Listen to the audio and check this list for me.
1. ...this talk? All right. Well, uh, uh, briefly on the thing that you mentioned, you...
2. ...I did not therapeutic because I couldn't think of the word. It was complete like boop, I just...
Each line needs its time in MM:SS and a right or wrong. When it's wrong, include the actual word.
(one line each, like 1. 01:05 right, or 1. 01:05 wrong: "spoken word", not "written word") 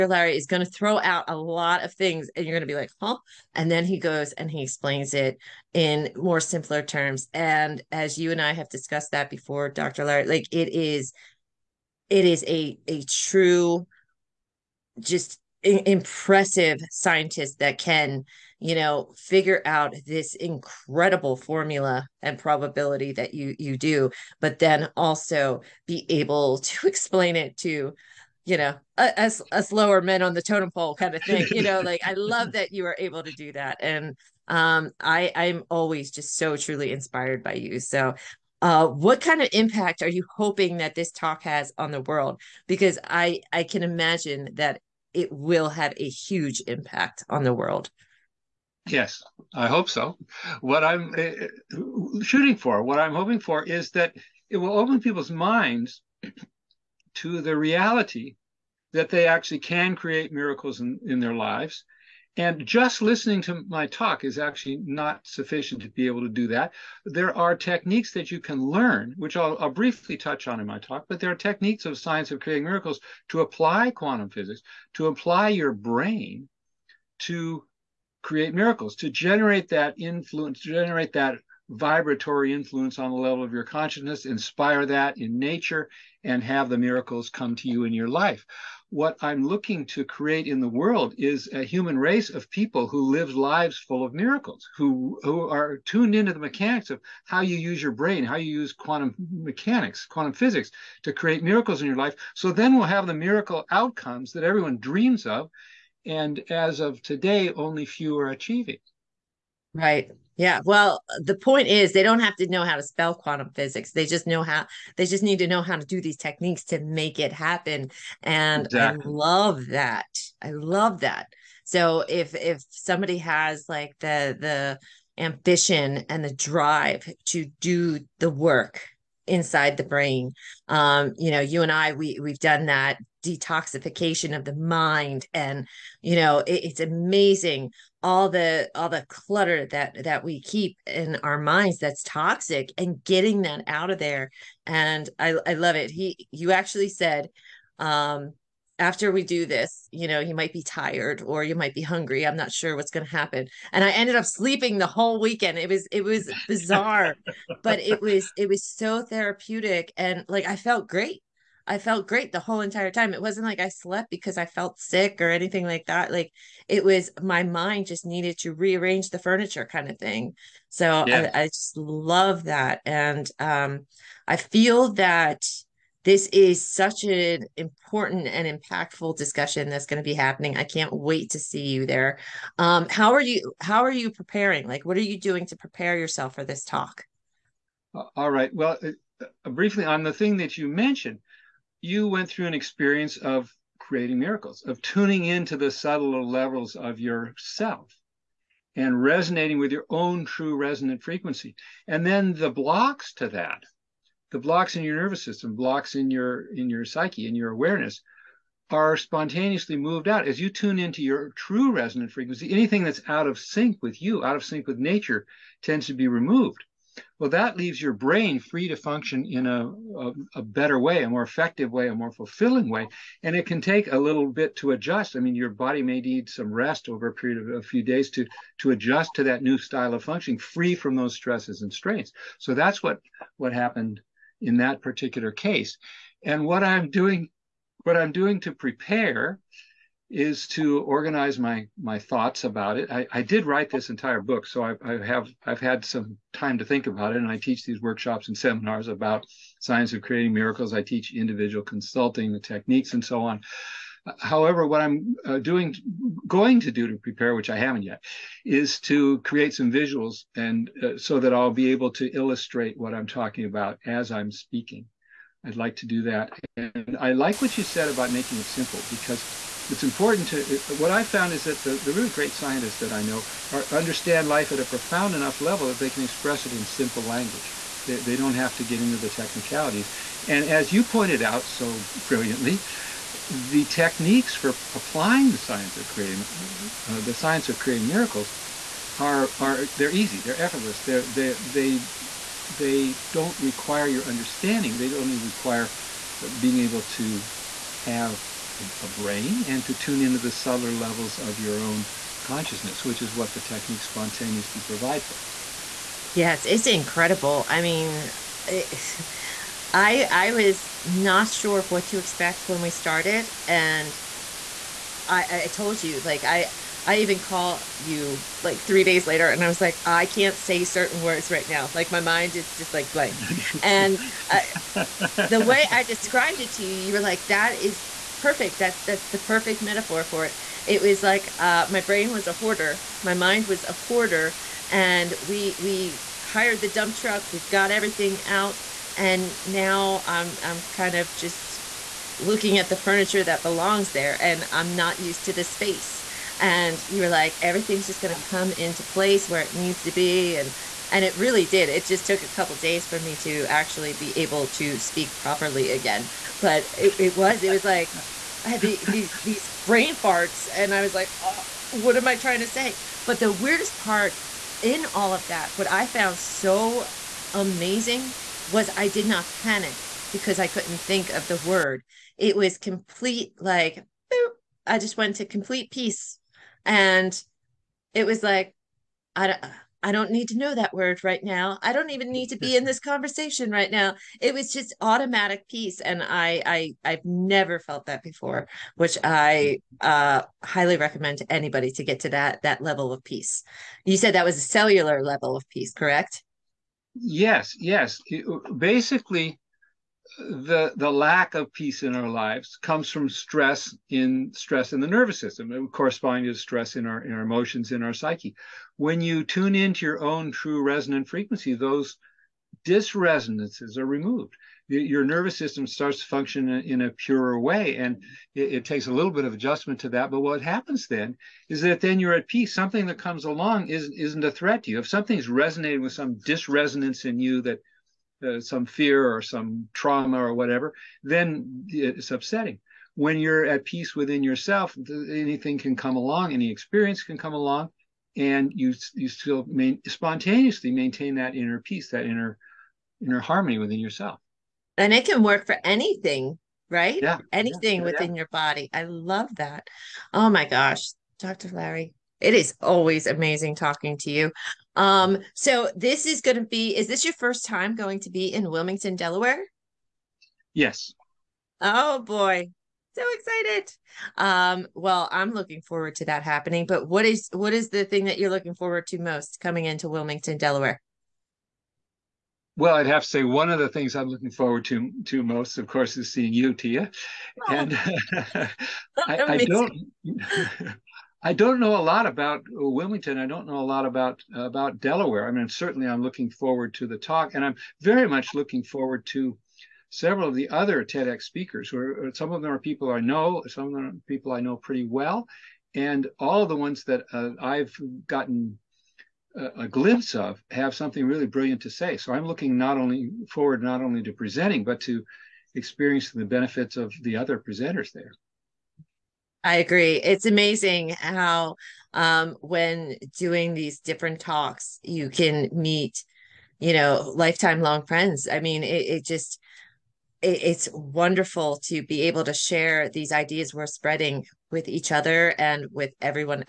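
1. 03:06 right
2. 06:08 wrong: "panic", not "therapeutic".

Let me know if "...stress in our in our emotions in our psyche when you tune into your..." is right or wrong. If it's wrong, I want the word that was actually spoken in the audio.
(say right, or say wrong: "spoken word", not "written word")
right.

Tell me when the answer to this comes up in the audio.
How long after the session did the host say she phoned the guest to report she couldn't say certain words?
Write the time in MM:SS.
05:18.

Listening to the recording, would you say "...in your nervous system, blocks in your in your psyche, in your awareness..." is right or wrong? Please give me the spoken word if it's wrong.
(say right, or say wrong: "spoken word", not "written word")
right.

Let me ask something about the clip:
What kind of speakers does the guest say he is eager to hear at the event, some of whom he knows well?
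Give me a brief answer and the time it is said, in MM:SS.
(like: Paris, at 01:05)
TEDx speakers, at 08:10.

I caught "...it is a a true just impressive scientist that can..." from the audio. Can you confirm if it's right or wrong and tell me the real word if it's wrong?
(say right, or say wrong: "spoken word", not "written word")
right.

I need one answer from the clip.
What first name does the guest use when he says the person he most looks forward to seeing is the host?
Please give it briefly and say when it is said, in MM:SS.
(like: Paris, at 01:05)
Tia, at 07:56.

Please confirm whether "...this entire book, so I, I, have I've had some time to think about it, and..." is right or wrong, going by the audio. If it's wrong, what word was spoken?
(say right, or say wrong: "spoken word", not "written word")
right.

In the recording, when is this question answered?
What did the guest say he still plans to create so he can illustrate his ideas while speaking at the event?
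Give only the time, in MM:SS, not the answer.
04:19.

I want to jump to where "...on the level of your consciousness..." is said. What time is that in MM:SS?
01:22.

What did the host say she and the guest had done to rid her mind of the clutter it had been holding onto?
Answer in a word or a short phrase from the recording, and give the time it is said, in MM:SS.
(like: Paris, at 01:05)
detoxification of the mind, at 02:13.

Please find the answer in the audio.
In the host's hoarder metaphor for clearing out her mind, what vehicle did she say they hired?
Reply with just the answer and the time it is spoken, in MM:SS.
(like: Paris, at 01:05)
dump truck, at 05:36.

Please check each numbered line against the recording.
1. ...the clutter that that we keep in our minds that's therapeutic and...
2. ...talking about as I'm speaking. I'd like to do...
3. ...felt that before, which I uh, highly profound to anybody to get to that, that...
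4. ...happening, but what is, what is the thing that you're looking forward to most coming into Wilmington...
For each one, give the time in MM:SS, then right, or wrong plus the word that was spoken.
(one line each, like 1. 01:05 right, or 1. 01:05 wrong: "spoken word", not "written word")
1. 02:18 wrong: "toxic", not "therapeutic"
2. 04:23 right
3. 06:27 wrong: "recommend", not "profound"
4. 07:46 right.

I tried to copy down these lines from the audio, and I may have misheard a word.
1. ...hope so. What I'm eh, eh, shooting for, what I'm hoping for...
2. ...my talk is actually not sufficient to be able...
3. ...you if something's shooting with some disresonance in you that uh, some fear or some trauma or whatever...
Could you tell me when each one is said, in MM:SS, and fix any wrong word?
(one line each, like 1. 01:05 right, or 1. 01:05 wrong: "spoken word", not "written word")
1. 00:49 right
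2. 01:03 right
3. 07:04 wrong: "resonating", not "shooting".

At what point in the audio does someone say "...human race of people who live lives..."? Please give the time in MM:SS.
01:31.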